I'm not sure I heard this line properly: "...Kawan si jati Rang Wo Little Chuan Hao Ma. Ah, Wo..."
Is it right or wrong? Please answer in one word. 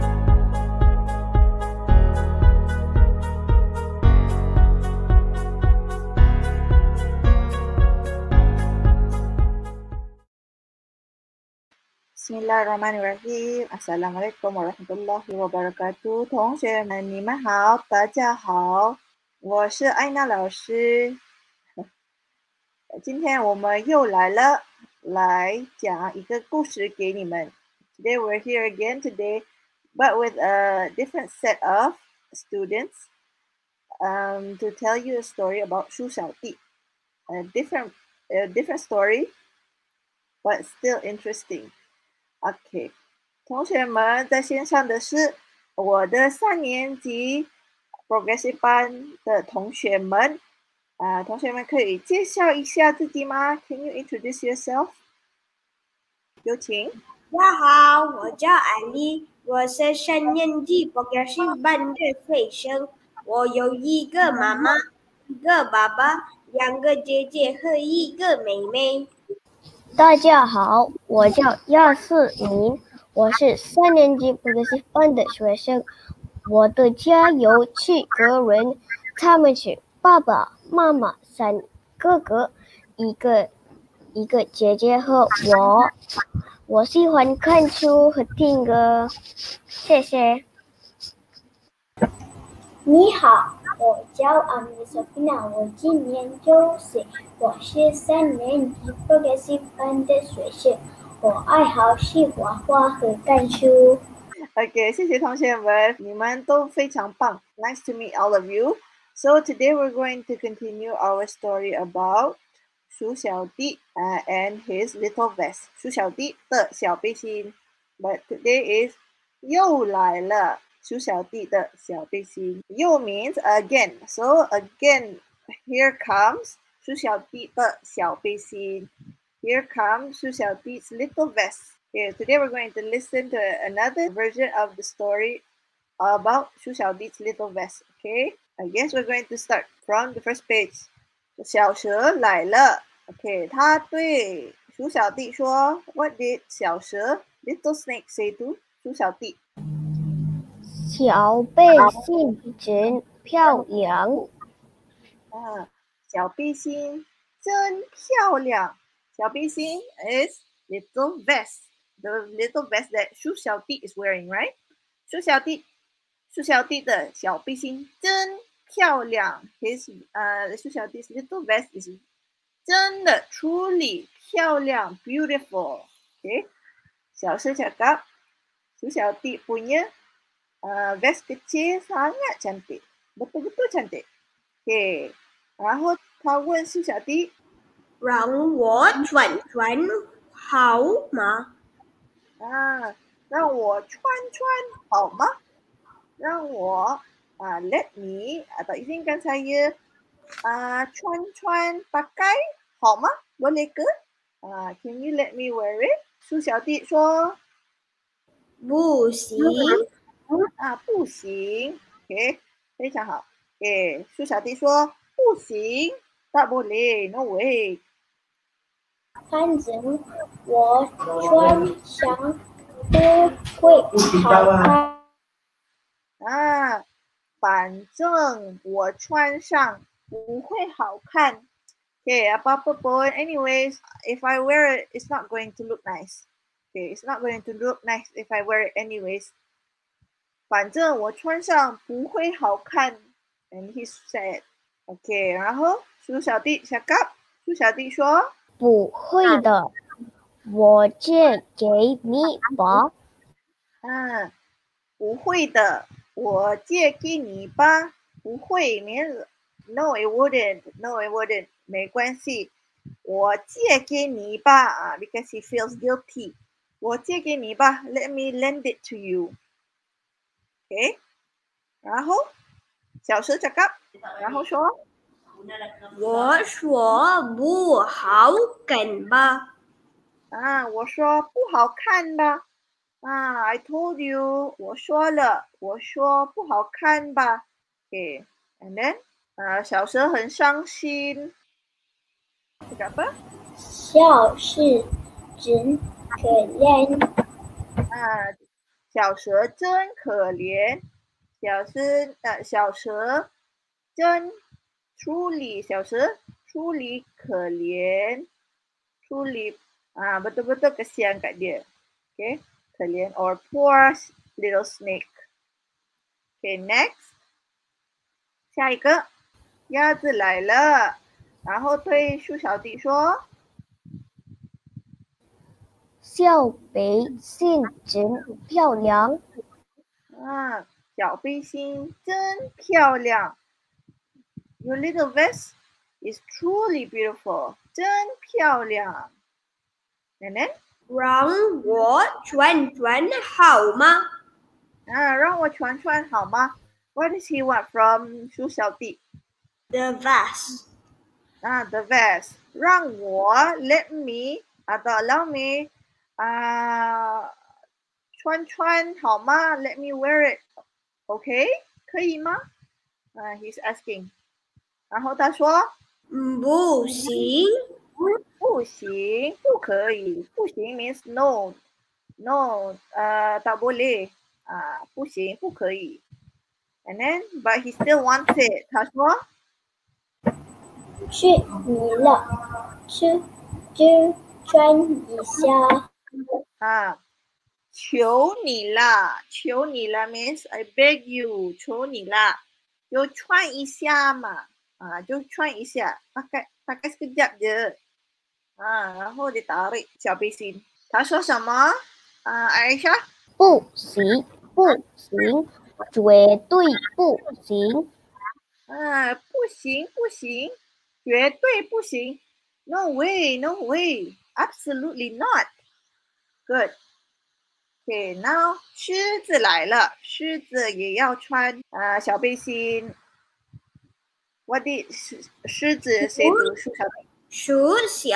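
wrong.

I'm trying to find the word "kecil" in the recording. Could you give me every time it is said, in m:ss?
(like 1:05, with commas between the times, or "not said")
3:01.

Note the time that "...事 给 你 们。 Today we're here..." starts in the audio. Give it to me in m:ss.
0:26.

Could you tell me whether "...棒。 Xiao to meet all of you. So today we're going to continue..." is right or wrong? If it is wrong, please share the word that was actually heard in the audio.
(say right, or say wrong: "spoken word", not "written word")
wrong: "Nice", not "Xiao".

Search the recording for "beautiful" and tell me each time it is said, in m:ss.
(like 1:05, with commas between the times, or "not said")
2:55, 5:36.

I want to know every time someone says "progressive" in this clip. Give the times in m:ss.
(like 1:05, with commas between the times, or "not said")
0:48, 1:00.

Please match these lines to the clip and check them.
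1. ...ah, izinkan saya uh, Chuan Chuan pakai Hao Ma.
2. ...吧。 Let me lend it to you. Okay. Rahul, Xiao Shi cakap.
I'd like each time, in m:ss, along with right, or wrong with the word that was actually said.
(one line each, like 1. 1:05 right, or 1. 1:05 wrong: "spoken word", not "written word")
1. 3:18 right
2. 4:27 right.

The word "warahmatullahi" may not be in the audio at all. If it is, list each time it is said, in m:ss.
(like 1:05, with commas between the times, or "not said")
0:14.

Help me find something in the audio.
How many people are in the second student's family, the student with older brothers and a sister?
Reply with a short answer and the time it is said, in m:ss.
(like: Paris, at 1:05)
7, at 1:17.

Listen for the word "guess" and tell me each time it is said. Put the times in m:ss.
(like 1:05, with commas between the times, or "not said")
2:18.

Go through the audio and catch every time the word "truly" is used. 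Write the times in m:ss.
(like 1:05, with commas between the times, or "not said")
2:53, 5:36.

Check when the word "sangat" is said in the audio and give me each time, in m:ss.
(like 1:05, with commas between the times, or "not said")
3:01.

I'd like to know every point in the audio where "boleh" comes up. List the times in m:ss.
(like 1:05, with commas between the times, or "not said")
3:23, 6:13.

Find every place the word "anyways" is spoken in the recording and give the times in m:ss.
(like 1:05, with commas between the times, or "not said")
3:53, 3:58.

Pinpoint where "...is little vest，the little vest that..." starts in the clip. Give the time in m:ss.
2:40.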